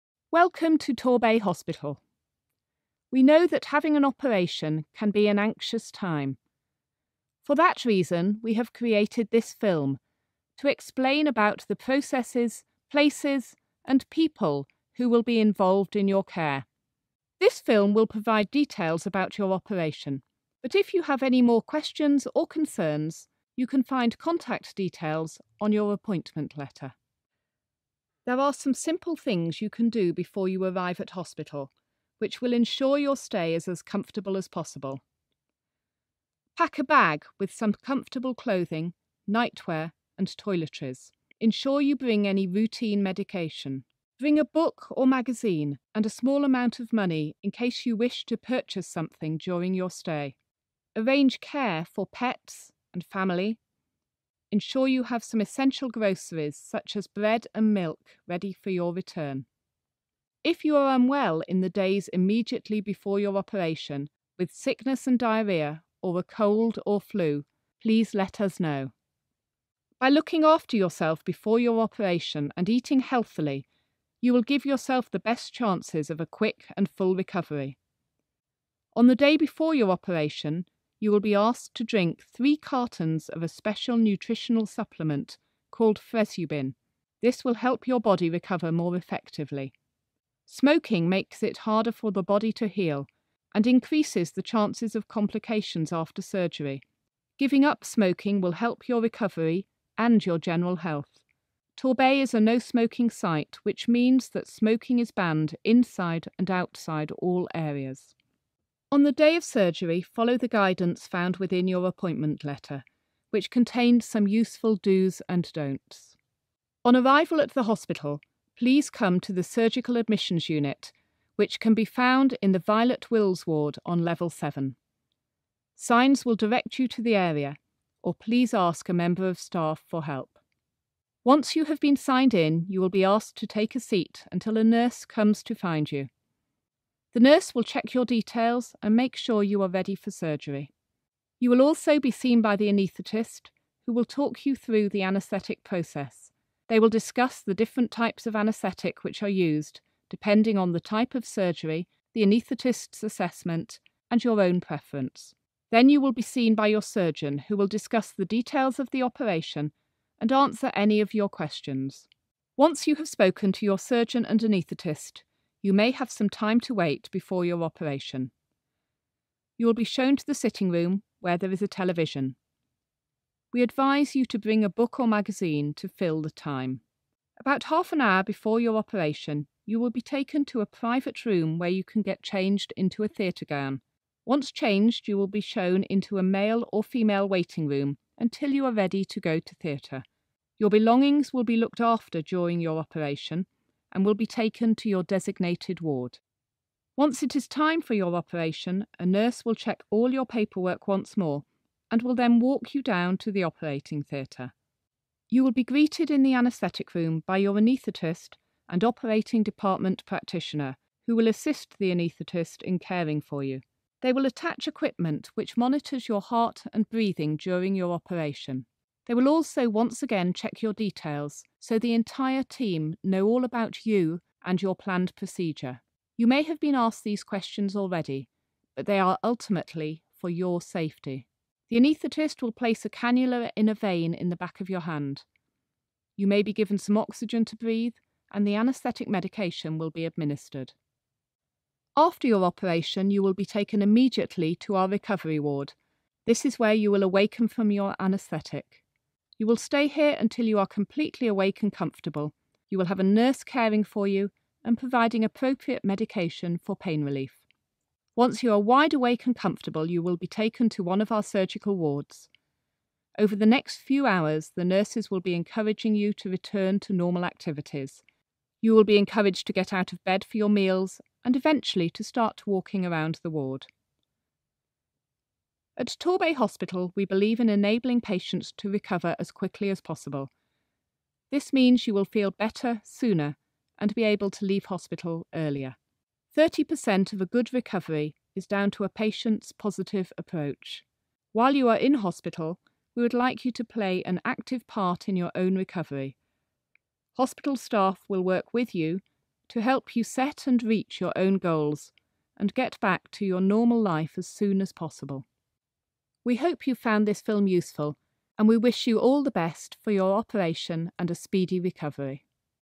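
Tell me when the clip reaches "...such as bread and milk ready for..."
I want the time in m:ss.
0:56.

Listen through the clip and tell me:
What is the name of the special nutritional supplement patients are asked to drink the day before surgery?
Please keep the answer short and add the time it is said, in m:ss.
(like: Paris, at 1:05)
Fresubin, at 1:25.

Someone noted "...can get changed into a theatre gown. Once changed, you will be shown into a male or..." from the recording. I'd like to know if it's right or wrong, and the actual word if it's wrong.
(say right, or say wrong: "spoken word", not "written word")
right.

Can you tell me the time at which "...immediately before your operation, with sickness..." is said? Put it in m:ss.
1:02.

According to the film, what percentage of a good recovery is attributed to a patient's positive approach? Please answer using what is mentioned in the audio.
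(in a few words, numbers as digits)
30%.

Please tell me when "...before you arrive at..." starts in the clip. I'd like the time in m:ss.
0:30.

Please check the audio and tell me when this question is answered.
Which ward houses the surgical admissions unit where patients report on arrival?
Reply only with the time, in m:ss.
2:02.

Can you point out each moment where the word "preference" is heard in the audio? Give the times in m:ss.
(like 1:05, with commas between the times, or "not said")
2:34.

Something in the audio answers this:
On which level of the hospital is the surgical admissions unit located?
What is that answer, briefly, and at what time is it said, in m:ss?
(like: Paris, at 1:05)
7, at 2:04.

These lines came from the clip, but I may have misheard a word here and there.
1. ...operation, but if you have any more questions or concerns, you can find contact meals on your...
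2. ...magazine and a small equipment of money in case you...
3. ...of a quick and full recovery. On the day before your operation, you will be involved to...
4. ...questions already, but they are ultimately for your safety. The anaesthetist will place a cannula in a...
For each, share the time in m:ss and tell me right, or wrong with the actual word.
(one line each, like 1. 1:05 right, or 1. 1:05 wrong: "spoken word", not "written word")
1. 0:19 wrong: "details", not "meals"
2. 0:45 wrong: "amount", not "equipment"
3. 1:16 wrong: "asked", not "involved"
4. 3:47 right.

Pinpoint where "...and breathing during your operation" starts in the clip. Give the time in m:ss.
3:36.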